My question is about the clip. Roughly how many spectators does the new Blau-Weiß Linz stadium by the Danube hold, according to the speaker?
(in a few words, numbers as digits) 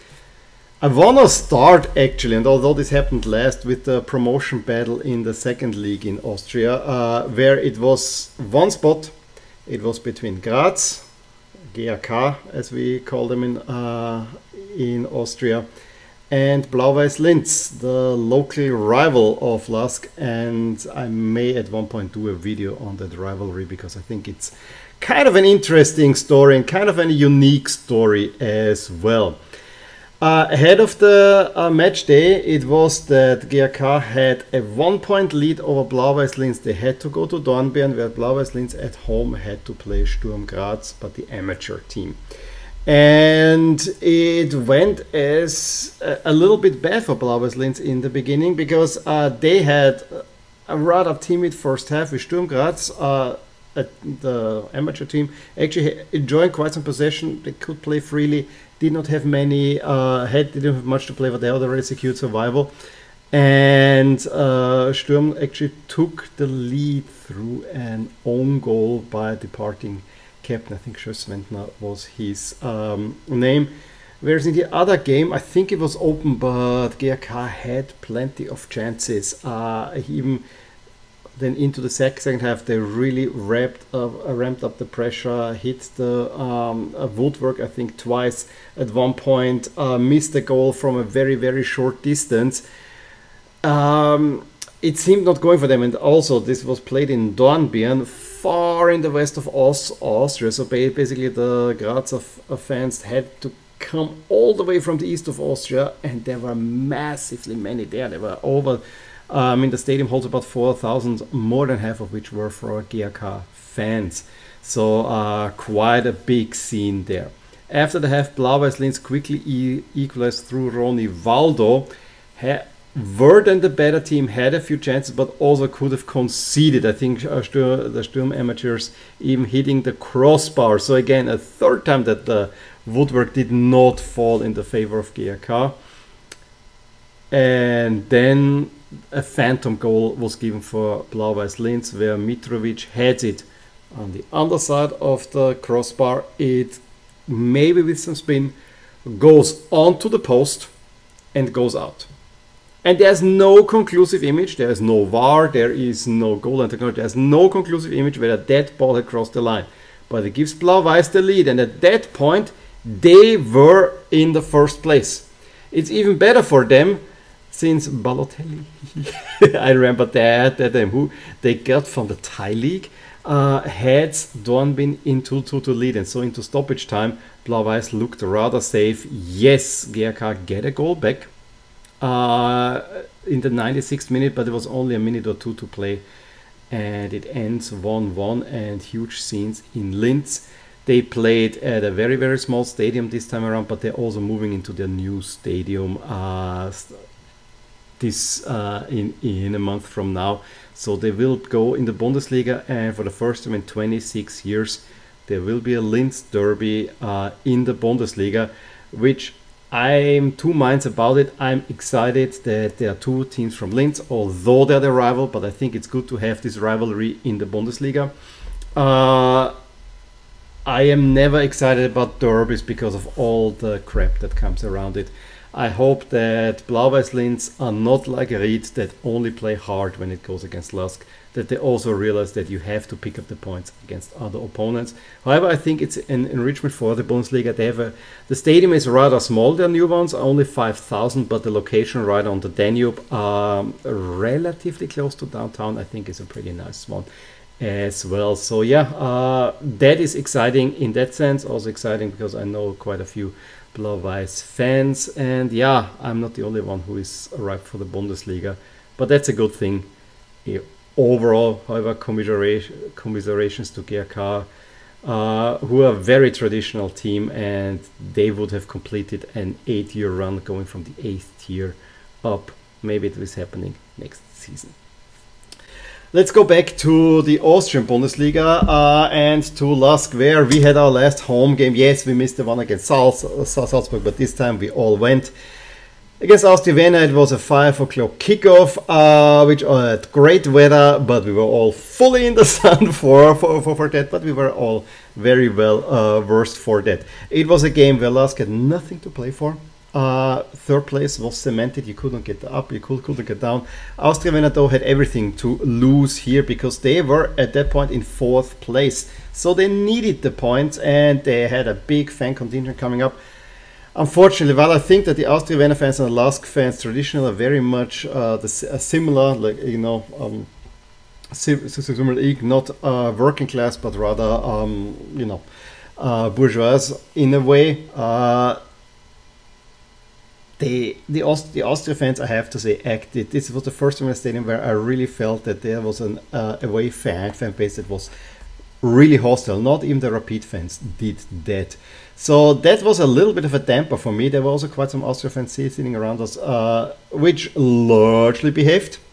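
5,000.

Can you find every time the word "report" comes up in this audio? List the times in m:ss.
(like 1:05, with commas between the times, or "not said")
not said.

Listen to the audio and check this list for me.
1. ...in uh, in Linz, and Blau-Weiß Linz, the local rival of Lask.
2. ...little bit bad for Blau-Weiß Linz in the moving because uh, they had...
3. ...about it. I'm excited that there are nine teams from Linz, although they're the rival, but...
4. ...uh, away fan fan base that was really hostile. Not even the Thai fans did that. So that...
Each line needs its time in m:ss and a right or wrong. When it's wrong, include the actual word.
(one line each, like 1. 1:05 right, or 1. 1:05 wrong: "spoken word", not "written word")
1. 0:13 wrong: "Austria", not "Linz"
2. 0:46 wrong: "beginning", not "moving"
3. 3:30 wrong: "two", not "nine"
4. 5:36 wrong: "Rapid", not "Thai".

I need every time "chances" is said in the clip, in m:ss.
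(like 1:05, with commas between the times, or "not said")
1:18, 2:04.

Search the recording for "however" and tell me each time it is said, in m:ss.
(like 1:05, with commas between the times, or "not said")
3:55, 4:21.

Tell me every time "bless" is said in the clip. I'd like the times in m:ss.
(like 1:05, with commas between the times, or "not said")
not said.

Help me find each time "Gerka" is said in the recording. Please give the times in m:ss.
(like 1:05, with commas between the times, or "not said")
2:59.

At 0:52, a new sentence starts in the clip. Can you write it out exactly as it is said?
Uh, uh, the amateur team actually enjoying quite some possession.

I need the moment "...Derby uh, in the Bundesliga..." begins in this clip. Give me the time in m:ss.
3:26.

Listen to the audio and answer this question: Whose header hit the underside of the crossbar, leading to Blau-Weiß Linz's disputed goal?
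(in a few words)
Mitrovic.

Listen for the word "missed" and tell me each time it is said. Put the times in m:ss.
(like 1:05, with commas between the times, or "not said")
1:29, 4:42.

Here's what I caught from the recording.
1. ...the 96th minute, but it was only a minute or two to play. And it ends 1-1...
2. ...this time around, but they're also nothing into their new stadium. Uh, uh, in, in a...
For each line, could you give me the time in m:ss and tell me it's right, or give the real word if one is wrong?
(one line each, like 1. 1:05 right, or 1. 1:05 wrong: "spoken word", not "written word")
1. 3:03 right
2. 3:13 wrong: "moving", not "nothing".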